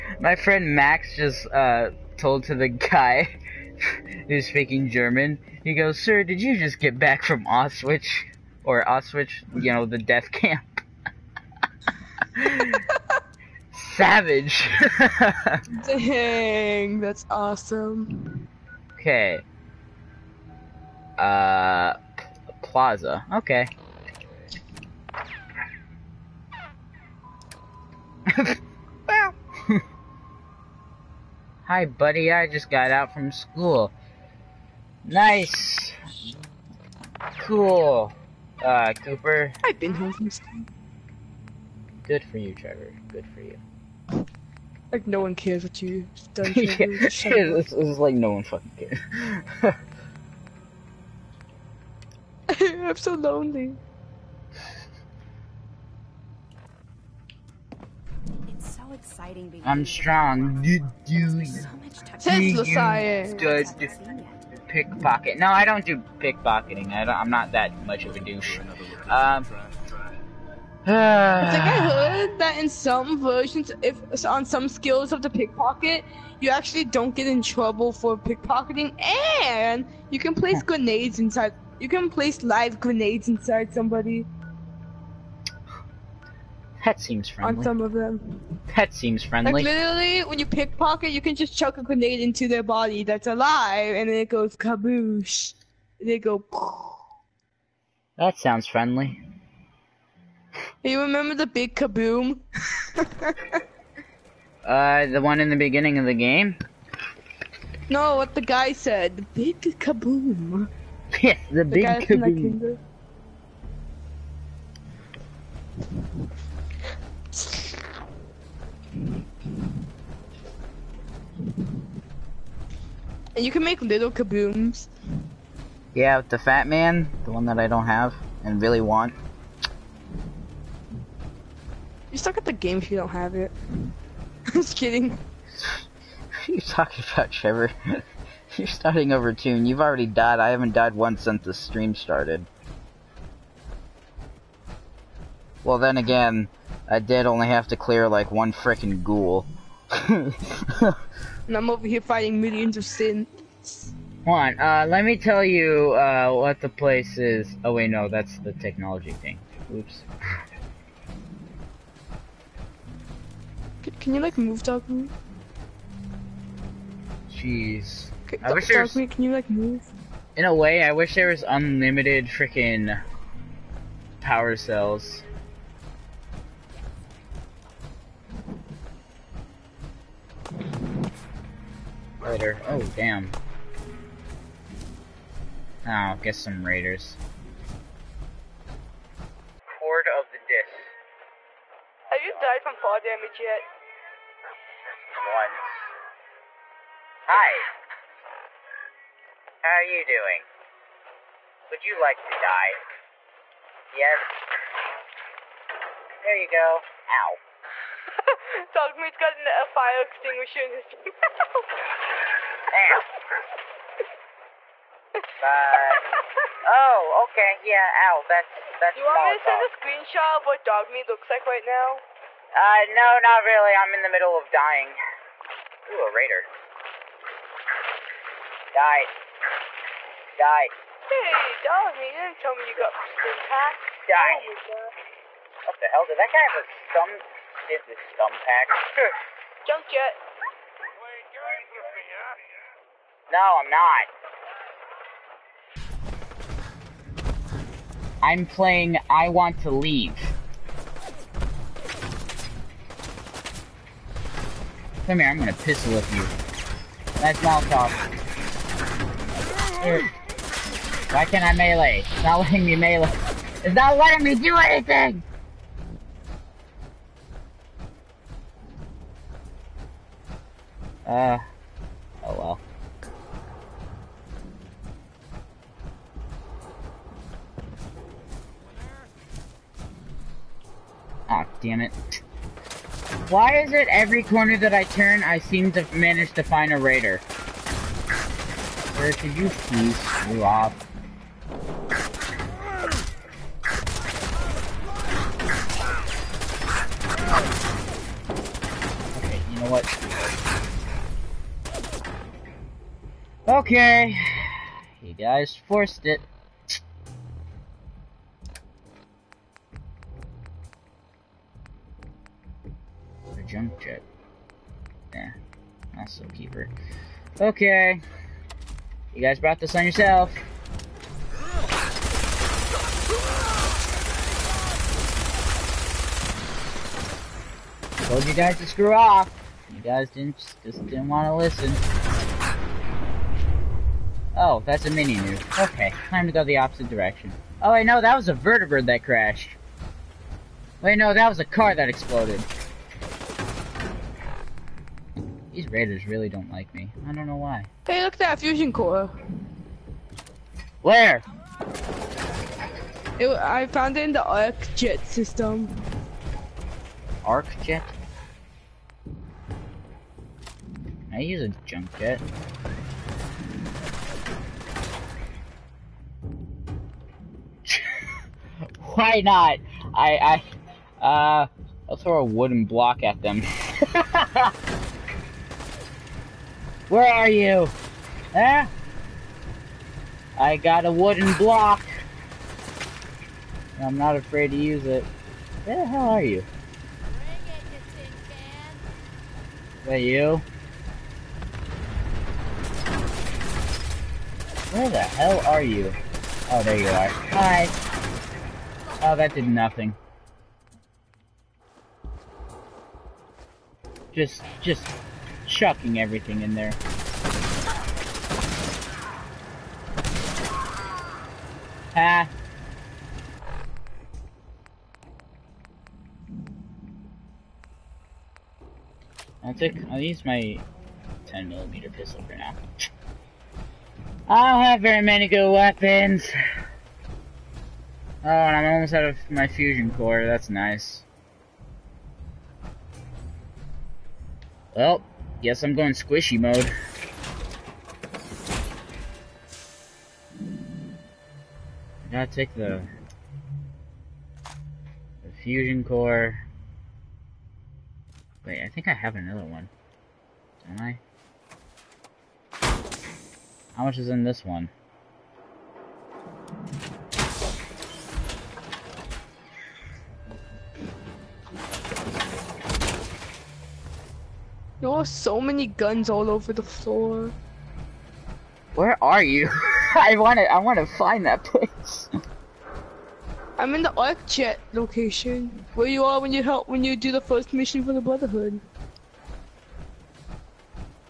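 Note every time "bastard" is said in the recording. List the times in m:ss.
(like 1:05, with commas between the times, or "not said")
not said.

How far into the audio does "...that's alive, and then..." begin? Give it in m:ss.
1:33.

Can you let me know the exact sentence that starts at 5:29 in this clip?
You guys didn't just didn't want to listen.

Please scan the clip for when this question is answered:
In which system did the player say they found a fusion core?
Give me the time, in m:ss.
5:54.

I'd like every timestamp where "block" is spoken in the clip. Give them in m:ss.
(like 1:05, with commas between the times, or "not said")
6:12, 6:21.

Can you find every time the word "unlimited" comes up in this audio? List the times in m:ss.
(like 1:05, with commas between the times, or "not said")
2:51.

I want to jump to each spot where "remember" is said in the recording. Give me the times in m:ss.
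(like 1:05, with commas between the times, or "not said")
1:41.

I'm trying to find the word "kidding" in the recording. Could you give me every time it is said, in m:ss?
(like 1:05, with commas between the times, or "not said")
2:14.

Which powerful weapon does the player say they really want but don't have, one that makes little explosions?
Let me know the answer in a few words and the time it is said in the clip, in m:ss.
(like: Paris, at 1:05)
Fat Man, at 2:06.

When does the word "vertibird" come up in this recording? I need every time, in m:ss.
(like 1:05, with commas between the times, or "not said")
5:38.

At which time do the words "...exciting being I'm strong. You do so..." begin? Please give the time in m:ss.
0:58.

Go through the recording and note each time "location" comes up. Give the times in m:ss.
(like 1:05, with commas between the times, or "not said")
7:54.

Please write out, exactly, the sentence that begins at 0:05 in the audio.
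He goes, "Sir, did you just get back from Auschwitz or Auschwitz?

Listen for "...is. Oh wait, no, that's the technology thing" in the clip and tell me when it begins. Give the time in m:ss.
2:37.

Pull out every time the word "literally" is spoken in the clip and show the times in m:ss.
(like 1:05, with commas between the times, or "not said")
1:29.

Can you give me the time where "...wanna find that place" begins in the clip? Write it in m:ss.
7:50.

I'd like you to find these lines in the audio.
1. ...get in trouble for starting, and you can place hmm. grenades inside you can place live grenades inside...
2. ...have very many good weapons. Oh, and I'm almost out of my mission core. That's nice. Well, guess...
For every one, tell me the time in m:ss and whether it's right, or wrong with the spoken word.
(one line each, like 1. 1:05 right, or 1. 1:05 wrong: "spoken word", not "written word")
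1. 1:17 wrong: "pickpocketing", not "starting"
2. 7:04 wrong: "fusion", not "mission".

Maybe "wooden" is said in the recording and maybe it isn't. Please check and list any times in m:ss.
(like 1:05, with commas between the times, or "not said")
6:12, 6:20.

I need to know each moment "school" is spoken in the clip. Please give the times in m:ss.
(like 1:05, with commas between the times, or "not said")
0:33, 0:40.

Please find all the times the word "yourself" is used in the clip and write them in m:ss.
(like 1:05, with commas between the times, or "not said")
5:19.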